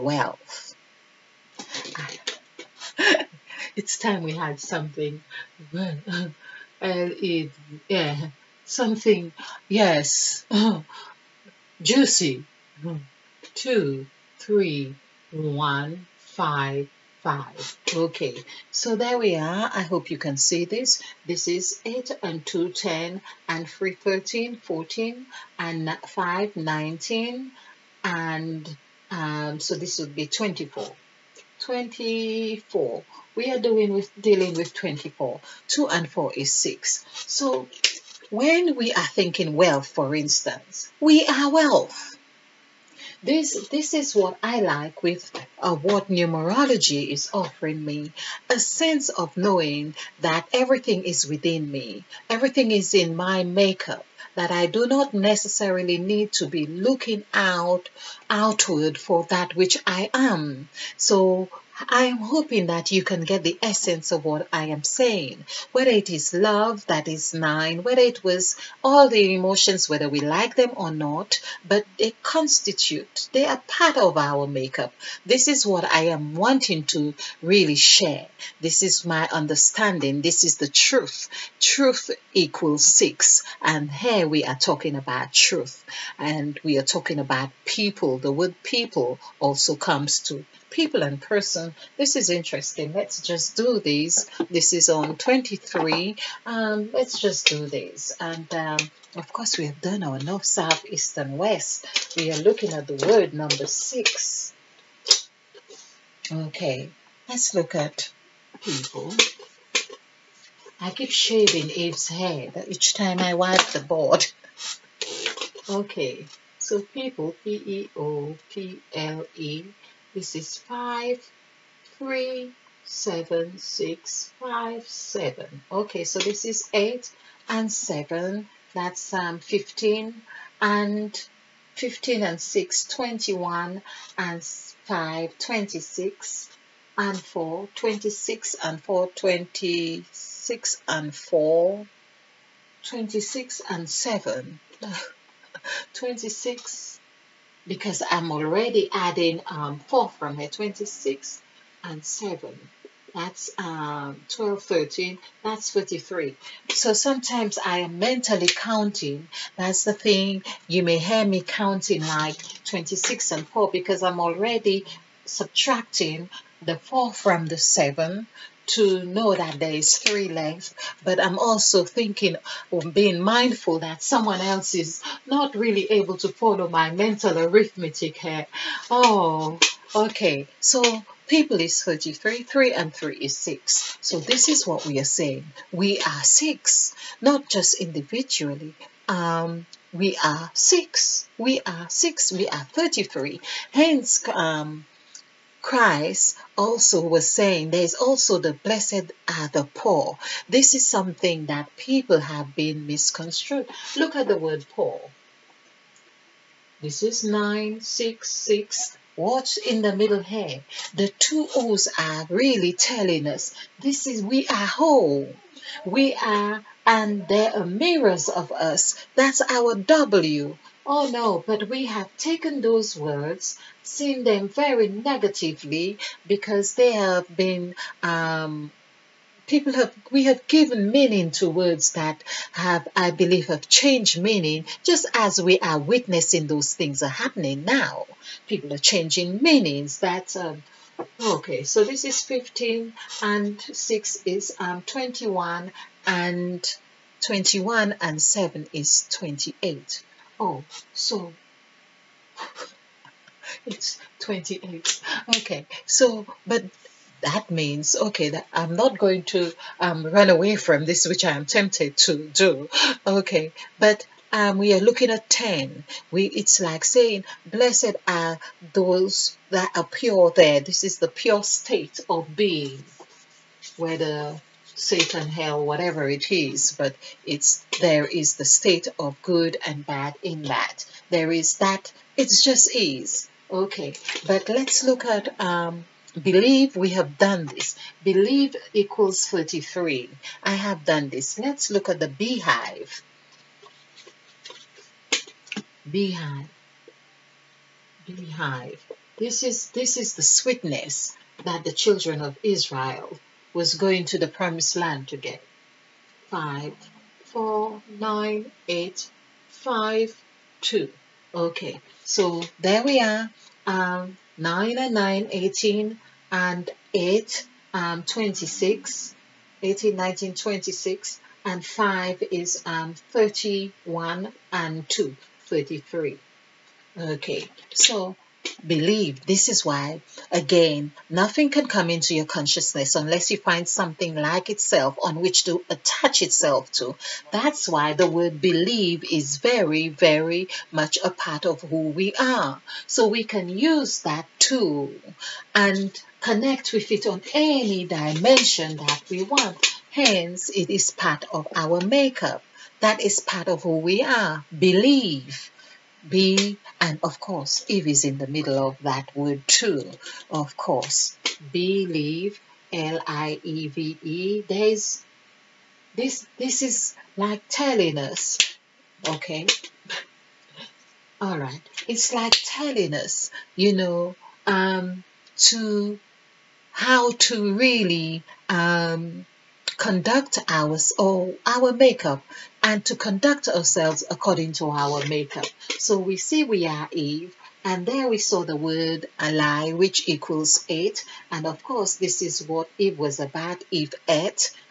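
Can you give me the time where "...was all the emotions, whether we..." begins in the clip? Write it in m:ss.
1:08.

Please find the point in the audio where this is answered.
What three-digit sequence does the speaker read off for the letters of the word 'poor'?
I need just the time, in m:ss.
3:27.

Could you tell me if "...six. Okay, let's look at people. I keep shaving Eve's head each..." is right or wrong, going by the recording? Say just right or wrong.
right.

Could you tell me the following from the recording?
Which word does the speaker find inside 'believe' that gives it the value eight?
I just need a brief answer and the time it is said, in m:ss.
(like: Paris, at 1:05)
Ally, at 6:29.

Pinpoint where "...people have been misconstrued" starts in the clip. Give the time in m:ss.
3:21.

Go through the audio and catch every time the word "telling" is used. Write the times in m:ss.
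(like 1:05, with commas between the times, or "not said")
3:32, 6:07, 6:12.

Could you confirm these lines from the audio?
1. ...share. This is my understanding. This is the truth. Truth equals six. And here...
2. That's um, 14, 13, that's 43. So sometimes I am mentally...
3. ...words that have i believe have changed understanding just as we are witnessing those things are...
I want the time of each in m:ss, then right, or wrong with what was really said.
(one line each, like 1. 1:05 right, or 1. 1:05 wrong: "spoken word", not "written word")
1. 1:17 right
2. 2:33 wrong: "12", not "14"
3. 3:51 wrong: "meaning", not "understanding".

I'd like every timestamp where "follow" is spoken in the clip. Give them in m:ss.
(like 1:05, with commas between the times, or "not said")
2:56.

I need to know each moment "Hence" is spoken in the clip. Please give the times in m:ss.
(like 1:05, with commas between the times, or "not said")
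3:13, 5:49.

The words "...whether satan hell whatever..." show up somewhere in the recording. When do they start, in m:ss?
4:33.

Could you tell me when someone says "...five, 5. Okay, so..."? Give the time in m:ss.
0:16.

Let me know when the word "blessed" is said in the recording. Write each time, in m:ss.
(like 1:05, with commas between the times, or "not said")
3:18, 4:27.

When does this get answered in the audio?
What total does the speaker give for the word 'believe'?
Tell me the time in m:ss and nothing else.
4:48.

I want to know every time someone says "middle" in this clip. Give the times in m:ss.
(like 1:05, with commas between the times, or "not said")
3:29, 5:58.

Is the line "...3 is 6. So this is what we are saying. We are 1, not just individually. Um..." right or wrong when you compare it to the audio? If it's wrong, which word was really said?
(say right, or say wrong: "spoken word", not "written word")
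wrong: "6", not "1".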